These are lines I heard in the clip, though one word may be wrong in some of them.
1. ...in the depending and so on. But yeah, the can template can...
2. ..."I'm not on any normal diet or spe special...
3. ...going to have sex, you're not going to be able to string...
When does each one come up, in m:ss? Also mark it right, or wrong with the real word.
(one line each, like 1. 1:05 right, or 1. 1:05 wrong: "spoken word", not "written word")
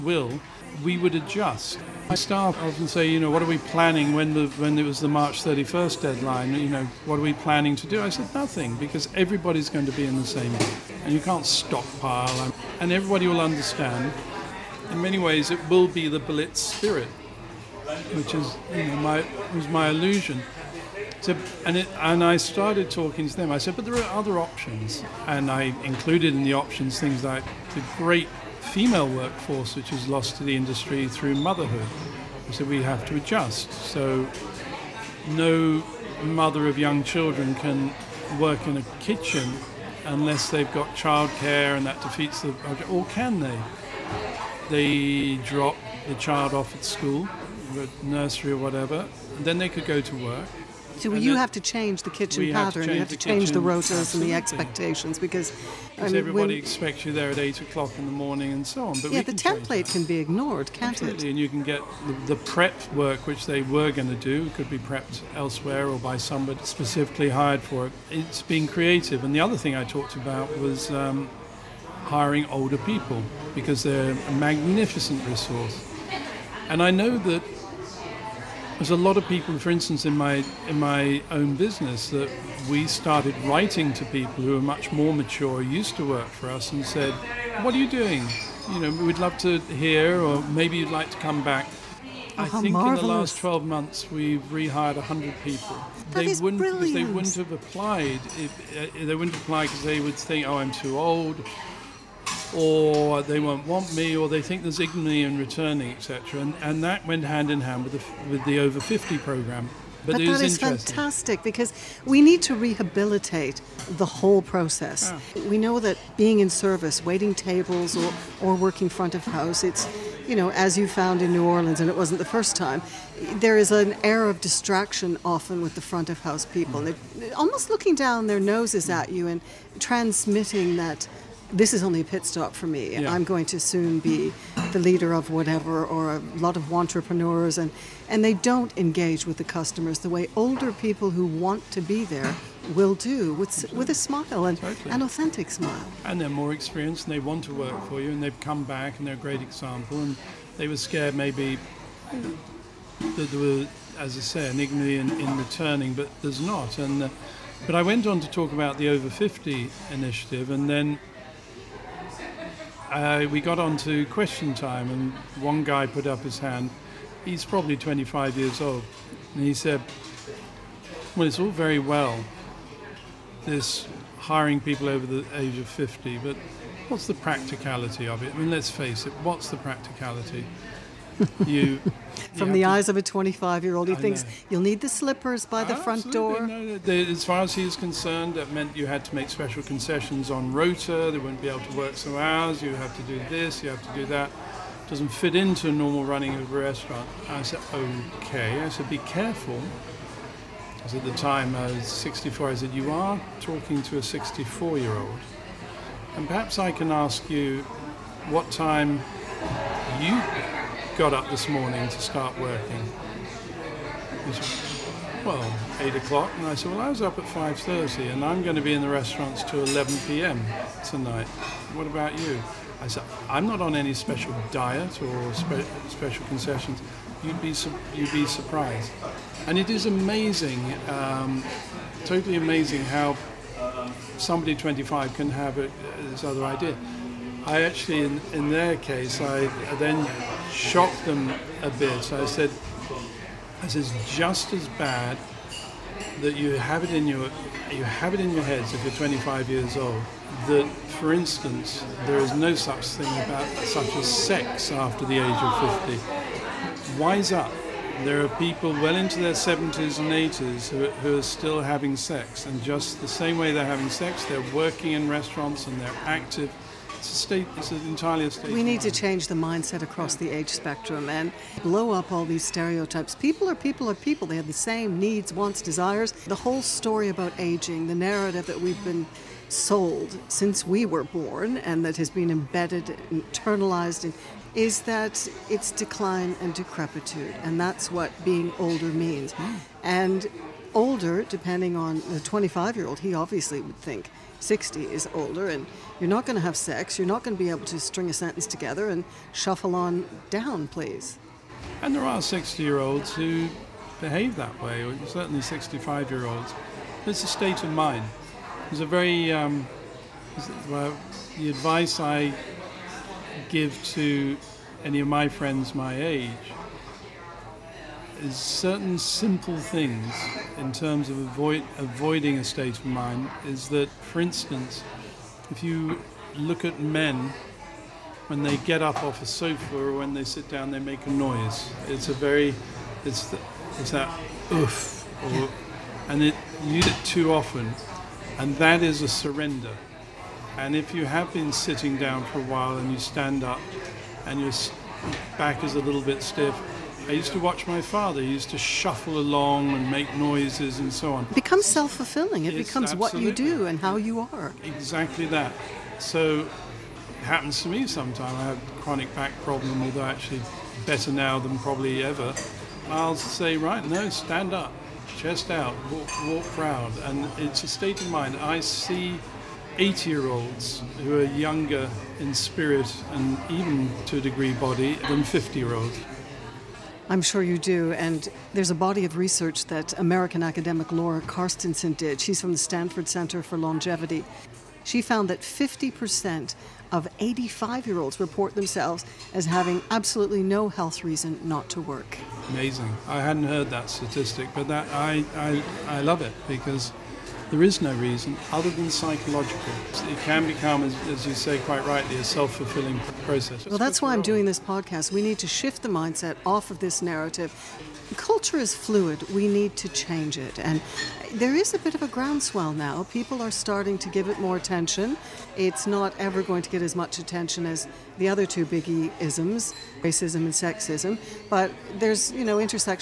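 1. 0:57 wrong: "morning", not "depending"
2. 3:43 wrong: "special", not "normal"
3. 4:56 right.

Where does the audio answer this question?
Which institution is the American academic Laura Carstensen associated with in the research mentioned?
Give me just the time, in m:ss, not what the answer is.
6:22.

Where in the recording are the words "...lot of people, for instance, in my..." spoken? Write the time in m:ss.
1:18.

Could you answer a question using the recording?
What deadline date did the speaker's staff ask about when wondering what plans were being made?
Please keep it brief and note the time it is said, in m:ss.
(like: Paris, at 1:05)
March 31st, at 0:05.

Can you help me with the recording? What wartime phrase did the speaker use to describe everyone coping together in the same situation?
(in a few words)
Blitz spirit.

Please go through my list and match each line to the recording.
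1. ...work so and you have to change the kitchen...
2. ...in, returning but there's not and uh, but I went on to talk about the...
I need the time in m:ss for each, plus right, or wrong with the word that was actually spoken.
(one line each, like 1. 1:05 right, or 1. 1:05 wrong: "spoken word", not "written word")
1. 0:50 right
2. 2:35 right.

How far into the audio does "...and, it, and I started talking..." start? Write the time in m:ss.
0:21.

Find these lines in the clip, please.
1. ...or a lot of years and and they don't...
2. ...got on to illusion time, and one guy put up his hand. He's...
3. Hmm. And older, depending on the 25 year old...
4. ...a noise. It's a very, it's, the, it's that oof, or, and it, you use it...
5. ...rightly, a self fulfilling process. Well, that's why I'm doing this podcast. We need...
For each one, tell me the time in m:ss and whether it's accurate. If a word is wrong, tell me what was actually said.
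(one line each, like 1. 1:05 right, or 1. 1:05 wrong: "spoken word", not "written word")
1. 2:15 wrong: "entrepreneurs", not "years"
2. 2:43 wrong: "question", not "illusion"
3. 4:49 right
4. 5:31 right
5. 6:41 right.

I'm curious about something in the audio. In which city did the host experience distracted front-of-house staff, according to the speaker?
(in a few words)
New Orleans.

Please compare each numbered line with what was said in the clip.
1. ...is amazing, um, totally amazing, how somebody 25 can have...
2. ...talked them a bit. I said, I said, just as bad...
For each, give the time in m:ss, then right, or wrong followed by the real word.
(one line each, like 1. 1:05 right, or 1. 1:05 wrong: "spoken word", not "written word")
1. 3:49 right
2. 4:00 wrong: "shocked", not "talked".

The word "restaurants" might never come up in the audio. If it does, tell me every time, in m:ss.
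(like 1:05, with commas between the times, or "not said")
3:16, 3:38, 4:25.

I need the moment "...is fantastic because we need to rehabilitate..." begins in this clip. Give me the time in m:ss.
1:50.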